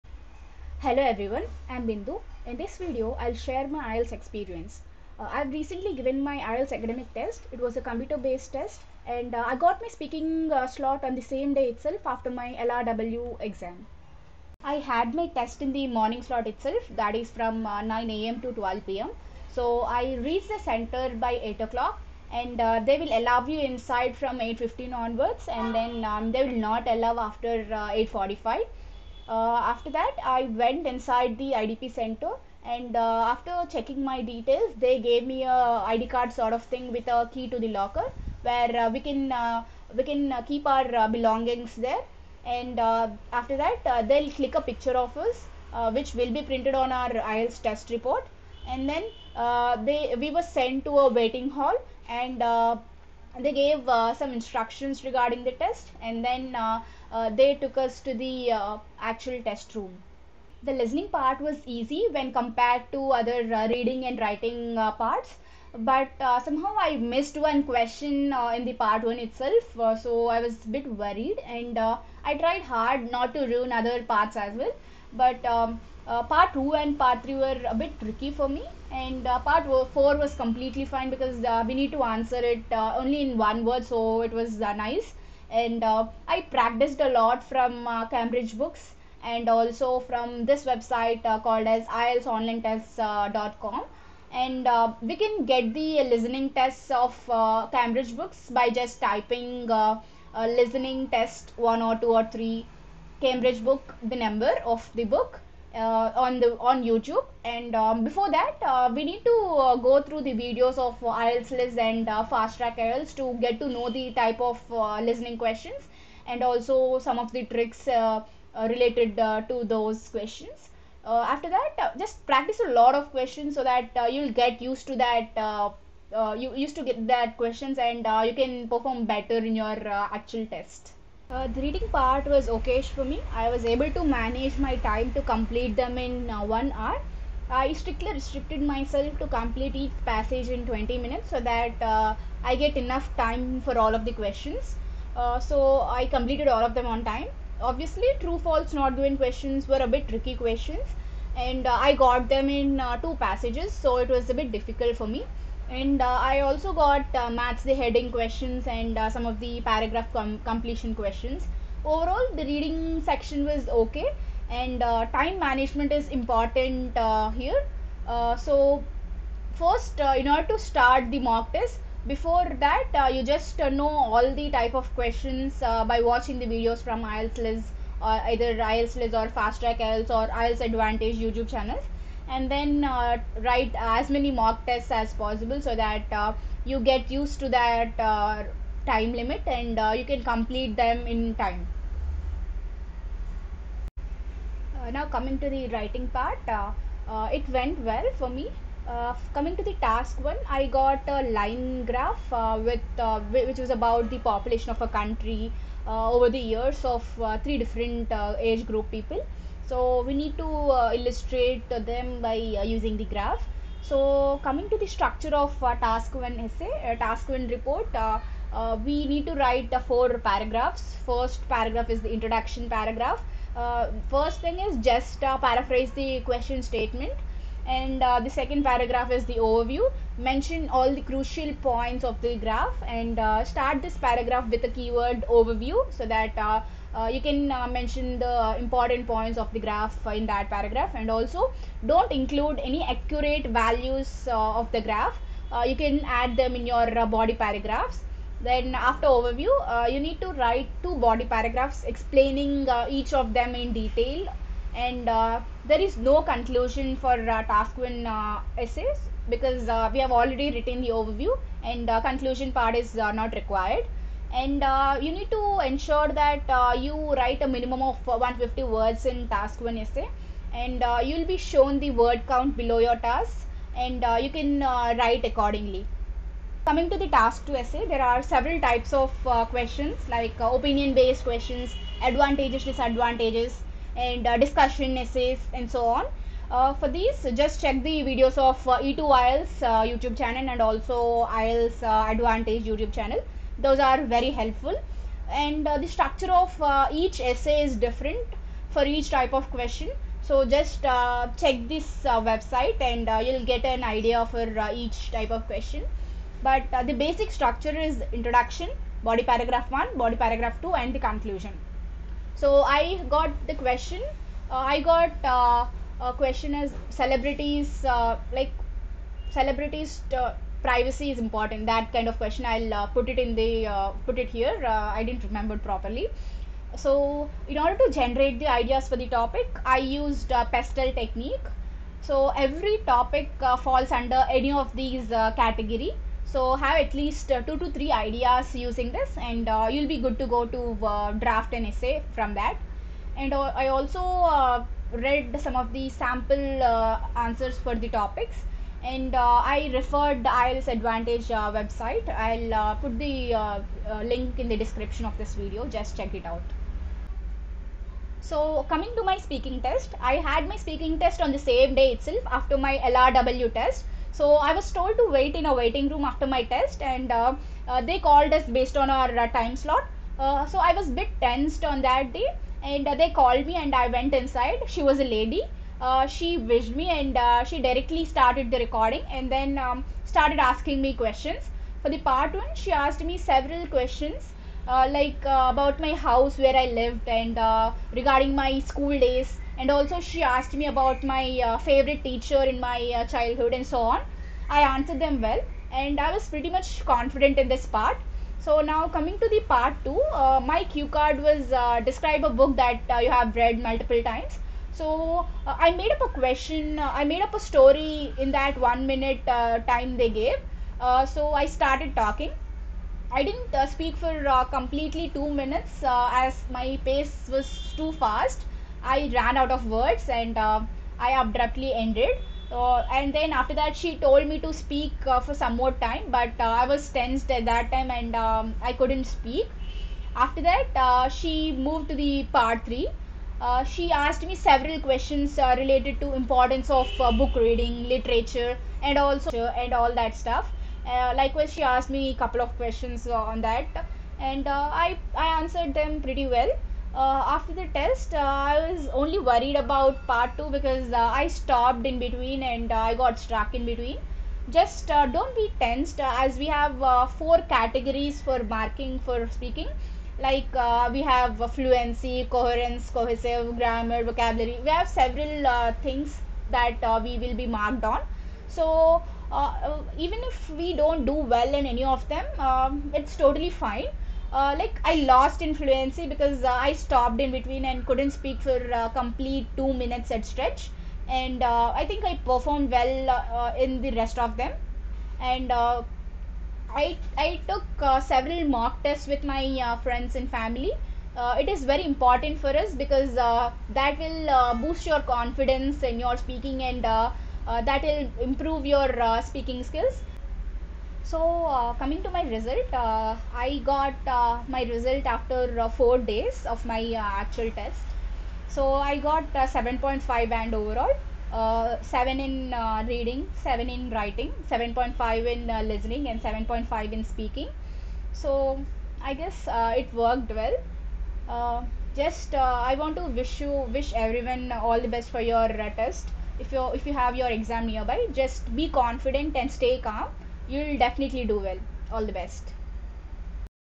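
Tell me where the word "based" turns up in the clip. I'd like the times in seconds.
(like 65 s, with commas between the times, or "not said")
7 s, 280 s, 368 s.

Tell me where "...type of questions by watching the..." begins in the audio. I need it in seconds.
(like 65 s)
174 s.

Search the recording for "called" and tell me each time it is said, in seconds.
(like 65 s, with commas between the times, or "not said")
91 s, 367 s, 373 s.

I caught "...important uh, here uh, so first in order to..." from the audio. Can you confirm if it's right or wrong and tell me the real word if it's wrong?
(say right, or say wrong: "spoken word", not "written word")
right.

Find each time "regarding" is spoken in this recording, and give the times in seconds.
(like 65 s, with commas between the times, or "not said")
55 s, 387 s.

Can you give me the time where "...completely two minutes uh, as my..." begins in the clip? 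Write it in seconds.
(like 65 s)
414 s.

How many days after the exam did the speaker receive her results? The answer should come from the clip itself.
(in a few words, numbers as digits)
4.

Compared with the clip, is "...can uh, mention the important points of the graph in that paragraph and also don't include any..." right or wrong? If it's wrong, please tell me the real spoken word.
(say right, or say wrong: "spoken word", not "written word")
right.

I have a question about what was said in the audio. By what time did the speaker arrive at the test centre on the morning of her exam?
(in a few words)
8 o'clock.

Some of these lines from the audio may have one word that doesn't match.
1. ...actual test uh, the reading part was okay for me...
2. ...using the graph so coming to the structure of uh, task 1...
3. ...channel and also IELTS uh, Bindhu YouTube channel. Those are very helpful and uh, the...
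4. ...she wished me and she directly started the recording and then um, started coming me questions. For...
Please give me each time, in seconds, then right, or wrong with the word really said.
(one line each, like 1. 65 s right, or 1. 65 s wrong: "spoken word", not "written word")
1. 129 s right
2. 212 s right
3. 290 s wrong: "Advantage", not "Bindhu"
4. 376 s wrong: "asking", not "coming".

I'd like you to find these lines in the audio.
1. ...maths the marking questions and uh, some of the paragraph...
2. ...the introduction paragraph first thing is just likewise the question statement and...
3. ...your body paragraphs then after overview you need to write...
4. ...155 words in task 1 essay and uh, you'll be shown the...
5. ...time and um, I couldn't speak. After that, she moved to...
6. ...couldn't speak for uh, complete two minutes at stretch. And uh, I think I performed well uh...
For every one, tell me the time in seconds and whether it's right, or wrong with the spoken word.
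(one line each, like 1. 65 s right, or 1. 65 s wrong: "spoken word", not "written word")
1. 157 s wrong: "heading", not "marking"
2. 222 s wrong: "paraphrase", not "likewise"
3. 246 s right
4. 268 s wrong: "150", not "155"
5. 427 s right
6. 477 s right.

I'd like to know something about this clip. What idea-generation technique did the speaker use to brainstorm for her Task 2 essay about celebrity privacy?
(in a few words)
PESTEL.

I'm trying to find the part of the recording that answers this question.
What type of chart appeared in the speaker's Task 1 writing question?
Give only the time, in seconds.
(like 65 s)
201 s.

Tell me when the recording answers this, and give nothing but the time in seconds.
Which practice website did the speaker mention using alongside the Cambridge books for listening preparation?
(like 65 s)
91 s.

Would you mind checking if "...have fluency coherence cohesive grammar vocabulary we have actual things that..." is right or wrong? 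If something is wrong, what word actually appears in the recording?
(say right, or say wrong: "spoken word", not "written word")
wrong: "several", not "actual".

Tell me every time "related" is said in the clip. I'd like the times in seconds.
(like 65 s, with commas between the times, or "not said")
118 s, 435 s.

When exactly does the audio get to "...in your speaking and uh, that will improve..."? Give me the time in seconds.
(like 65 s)
495 s.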